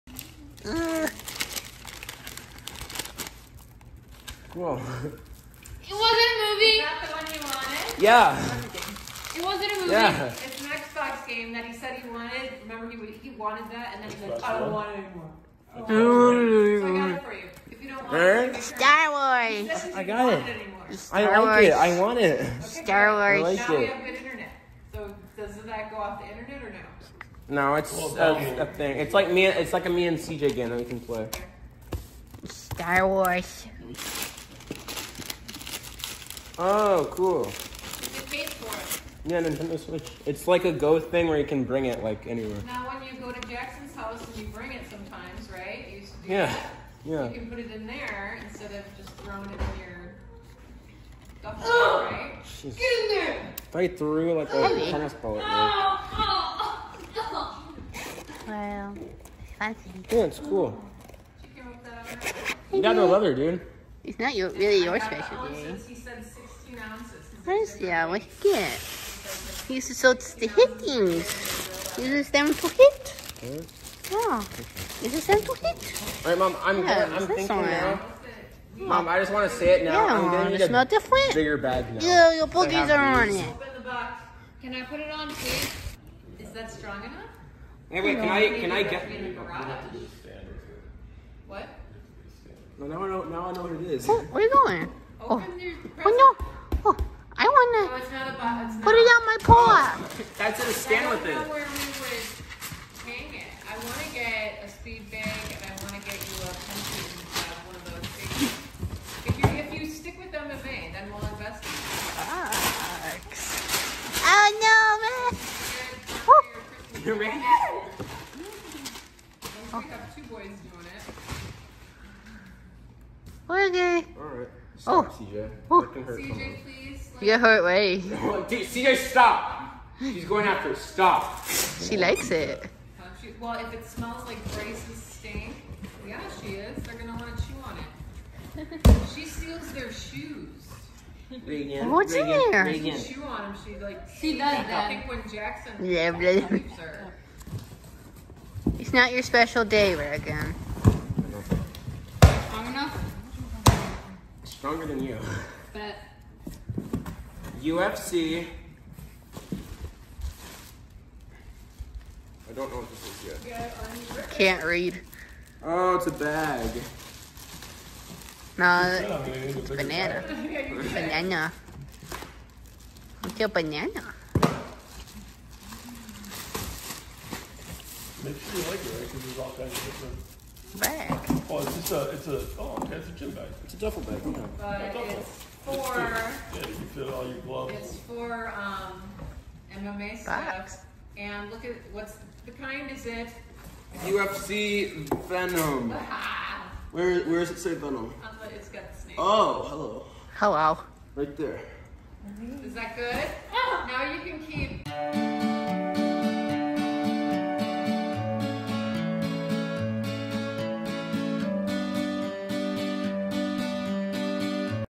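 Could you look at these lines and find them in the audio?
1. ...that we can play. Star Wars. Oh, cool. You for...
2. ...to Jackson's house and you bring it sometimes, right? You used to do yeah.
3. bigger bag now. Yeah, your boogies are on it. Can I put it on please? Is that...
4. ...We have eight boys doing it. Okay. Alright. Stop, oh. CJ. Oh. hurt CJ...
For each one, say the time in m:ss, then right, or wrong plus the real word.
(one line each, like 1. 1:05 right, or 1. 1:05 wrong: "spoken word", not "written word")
1. 0:30 right
2. 0:43 right
3. 1:21 right
4. 1:59 wrong: "two", not "eight".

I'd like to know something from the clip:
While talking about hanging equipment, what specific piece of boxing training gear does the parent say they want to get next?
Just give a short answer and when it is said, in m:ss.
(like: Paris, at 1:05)
Speed bag, at 1:44.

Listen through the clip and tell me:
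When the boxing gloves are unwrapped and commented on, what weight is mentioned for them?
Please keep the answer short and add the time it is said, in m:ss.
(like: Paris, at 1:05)
16 ounces, at 1:04.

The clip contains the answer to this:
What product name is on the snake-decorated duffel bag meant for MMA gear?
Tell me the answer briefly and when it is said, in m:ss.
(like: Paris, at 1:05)
UFC Venom, at 3:14.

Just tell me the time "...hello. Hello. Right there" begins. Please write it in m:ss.
3:19.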